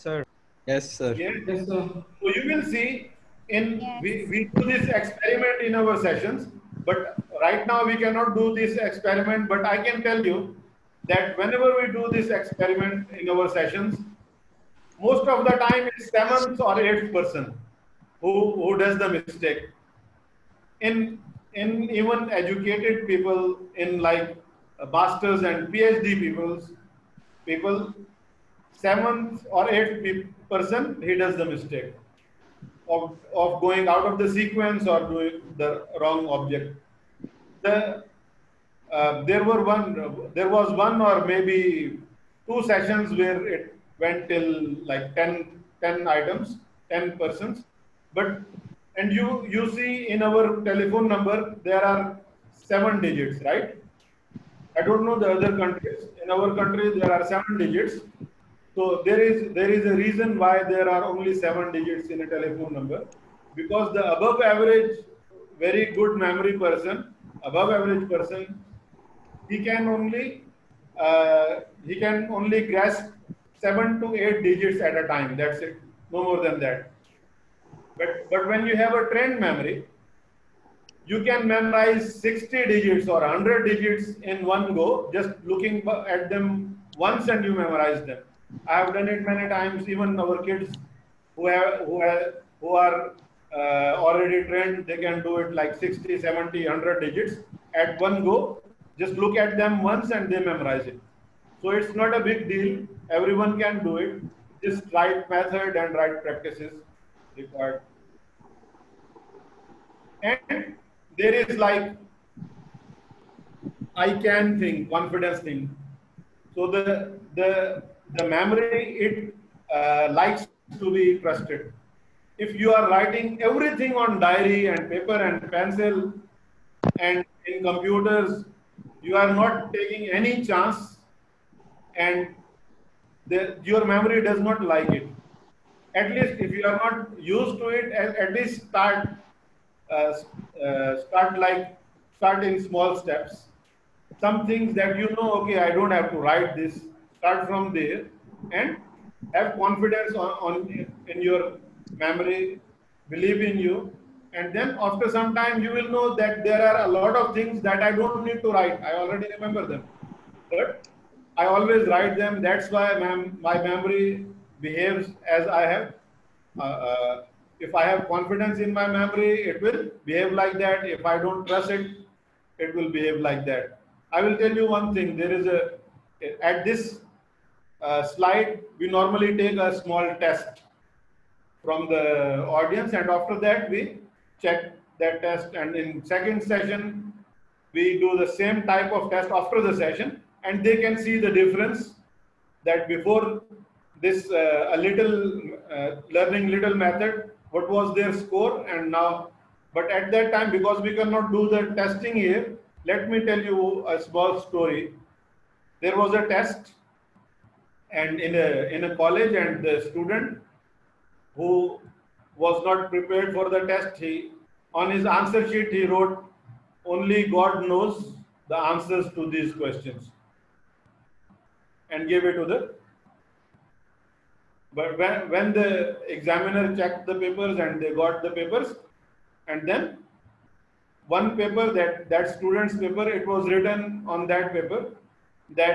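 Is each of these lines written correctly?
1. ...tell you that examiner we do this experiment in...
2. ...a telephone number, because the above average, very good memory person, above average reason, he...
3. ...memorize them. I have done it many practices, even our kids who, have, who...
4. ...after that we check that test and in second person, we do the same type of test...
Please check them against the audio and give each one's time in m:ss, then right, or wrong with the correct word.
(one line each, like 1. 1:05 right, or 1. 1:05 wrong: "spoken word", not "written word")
1. 0:10 wrong: "whenever", not "examiner"
2. 1:02 wrong: "person", not "reason"
3. 1:27 wrong: "times", not "practices"
4. 3:03 wrong: "session", not "person".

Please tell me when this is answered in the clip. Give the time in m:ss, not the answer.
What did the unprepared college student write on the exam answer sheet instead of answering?
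3:36.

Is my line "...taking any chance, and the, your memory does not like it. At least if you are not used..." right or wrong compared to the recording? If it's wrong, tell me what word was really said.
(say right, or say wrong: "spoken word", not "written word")
right.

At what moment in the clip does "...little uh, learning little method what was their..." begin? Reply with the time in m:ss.
3:14.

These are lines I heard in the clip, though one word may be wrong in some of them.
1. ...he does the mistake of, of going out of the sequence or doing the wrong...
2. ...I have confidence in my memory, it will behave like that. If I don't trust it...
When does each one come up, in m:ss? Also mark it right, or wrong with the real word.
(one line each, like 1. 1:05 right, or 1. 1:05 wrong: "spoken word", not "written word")
1. 0:31 right
2. 2:47 right.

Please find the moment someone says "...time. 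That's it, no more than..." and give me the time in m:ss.
1:15.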